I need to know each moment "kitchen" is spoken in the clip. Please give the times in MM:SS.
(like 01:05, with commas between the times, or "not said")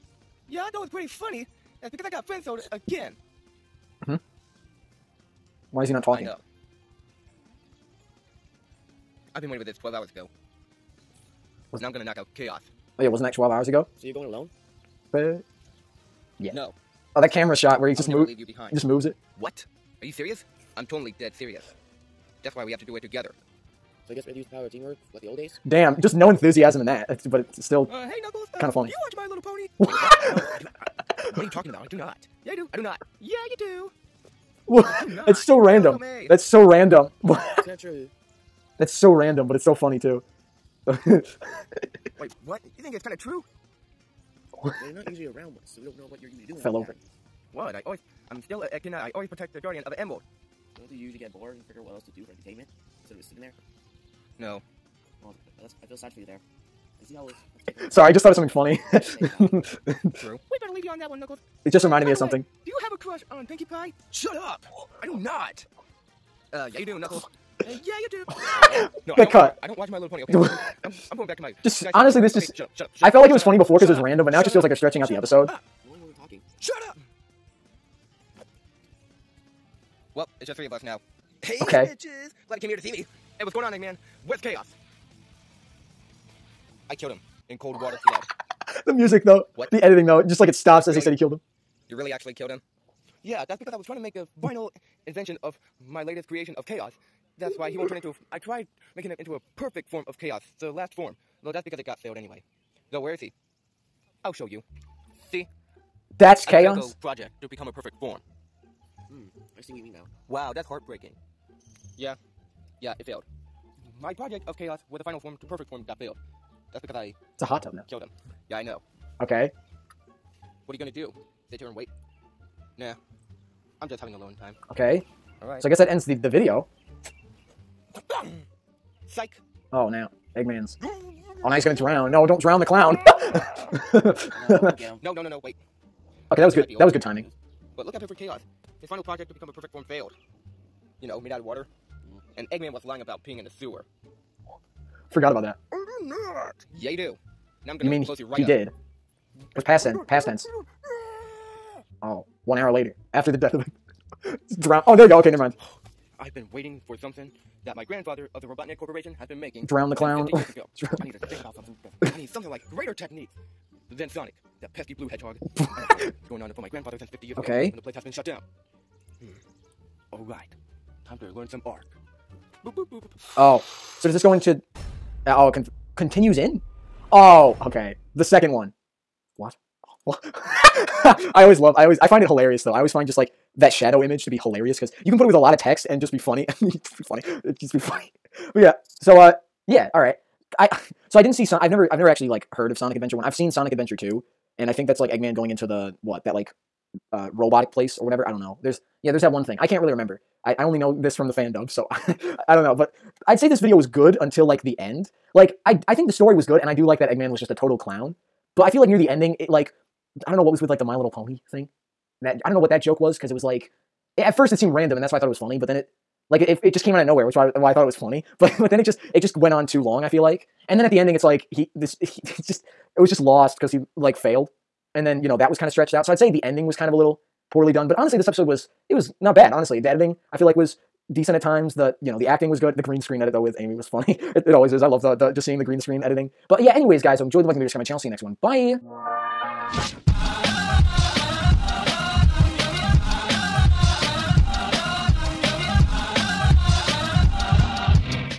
not said.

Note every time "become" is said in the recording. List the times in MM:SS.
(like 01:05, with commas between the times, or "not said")
01:47, 02:19.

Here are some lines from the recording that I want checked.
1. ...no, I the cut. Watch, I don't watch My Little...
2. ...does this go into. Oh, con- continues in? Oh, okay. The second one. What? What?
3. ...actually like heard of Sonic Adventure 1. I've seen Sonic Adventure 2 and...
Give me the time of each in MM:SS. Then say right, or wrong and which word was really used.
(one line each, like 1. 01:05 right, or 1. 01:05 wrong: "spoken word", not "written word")
1. 01:09 right
2. 02:54 right
3. 03:12 right.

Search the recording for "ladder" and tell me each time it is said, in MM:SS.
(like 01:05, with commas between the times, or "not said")
not said.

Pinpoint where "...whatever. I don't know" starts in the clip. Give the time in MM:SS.
03:18.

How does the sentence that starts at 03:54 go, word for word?
I love the the just seeing the green screen editing.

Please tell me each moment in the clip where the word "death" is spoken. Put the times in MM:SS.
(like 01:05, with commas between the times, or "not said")
02:33.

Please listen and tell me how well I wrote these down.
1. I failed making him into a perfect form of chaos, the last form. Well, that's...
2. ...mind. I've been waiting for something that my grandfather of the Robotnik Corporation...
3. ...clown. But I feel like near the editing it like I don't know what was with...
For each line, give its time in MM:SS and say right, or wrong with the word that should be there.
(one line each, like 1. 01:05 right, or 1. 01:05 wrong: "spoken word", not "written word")
1. 01:38 wrong: "tried", not "failed"
2. 02:35 right
3. 03:27 wrong: "ending", not "editing".